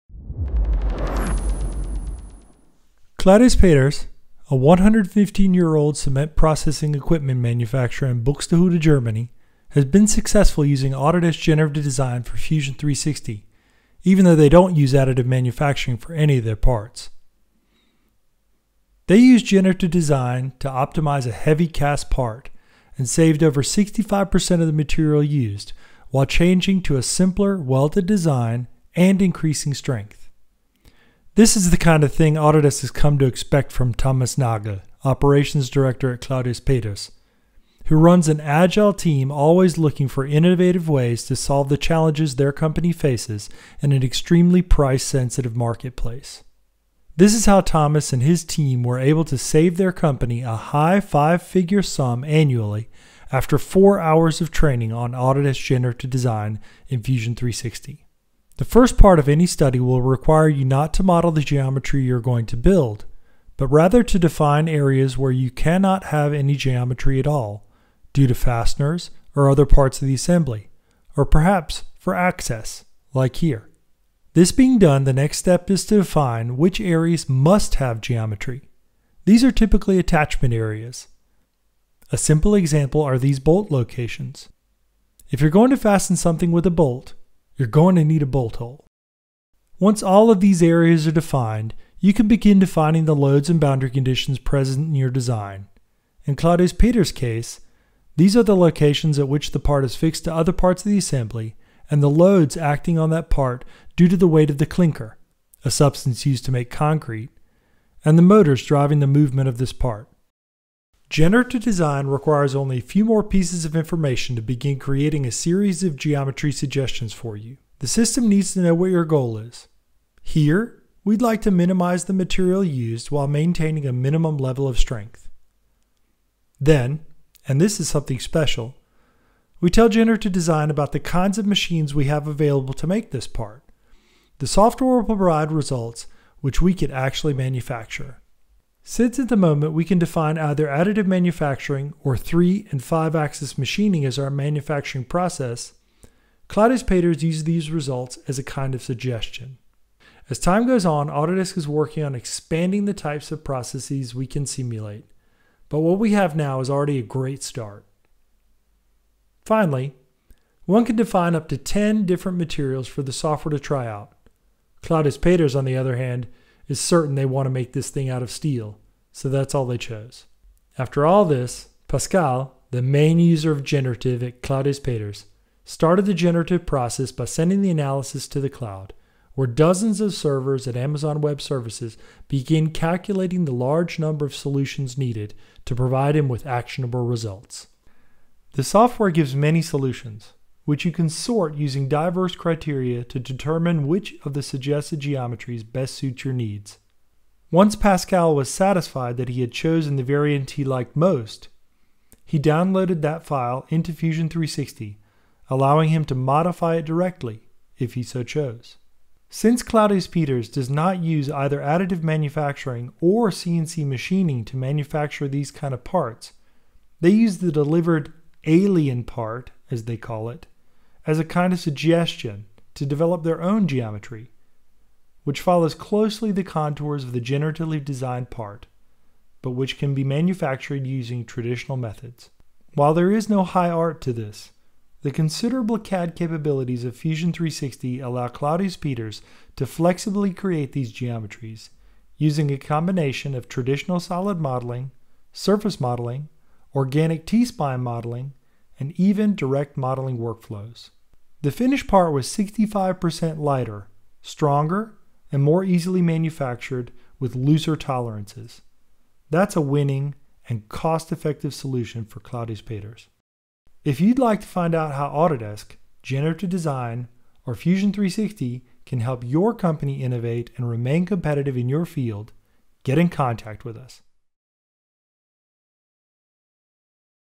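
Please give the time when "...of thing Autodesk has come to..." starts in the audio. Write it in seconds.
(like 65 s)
32 s.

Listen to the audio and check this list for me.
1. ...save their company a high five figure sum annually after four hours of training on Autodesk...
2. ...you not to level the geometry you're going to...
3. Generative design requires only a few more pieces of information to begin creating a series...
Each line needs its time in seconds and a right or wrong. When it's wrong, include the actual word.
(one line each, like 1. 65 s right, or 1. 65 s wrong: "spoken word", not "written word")
1. 49 s right
2. 60 s wrong: "model", not "level"
3. 111 s right.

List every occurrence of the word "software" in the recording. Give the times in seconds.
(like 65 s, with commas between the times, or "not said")
134 s, 163 s, 188 s.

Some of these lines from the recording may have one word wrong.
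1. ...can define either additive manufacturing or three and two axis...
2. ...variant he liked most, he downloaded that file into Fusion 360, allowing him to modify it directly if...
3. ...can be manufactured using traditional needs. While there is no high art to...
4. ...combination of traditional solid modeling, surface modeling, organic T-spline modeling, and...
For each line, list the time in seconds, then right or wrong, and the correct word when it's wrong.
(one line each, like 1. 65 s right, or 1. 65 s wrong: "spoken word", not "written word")
1. 139 s wrong: "five", not "two"
2. 200 s right
3. 229 s wrong: "methods", not "needs"
4. 242 s right.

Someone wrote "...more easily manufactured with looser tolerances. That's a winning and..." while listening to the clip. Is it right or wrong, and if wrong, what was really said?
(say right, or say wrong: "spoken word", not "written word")
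right.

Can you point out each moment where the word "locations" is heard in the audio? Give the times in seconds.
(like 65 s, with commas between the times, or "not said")
83 s, 98 s.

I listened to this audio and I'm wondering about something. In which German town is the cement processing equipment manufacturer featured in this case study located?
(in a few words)
Buxtehude.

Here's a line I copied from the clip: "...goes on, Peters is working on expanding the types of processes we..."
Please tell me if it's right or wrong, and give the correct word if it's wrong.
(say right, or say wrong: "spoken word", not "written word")
wrong: "Autodesk", not "Peters".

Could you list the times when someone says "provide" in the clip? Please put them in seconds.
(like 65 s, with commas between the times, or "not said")
135 s, 185 s.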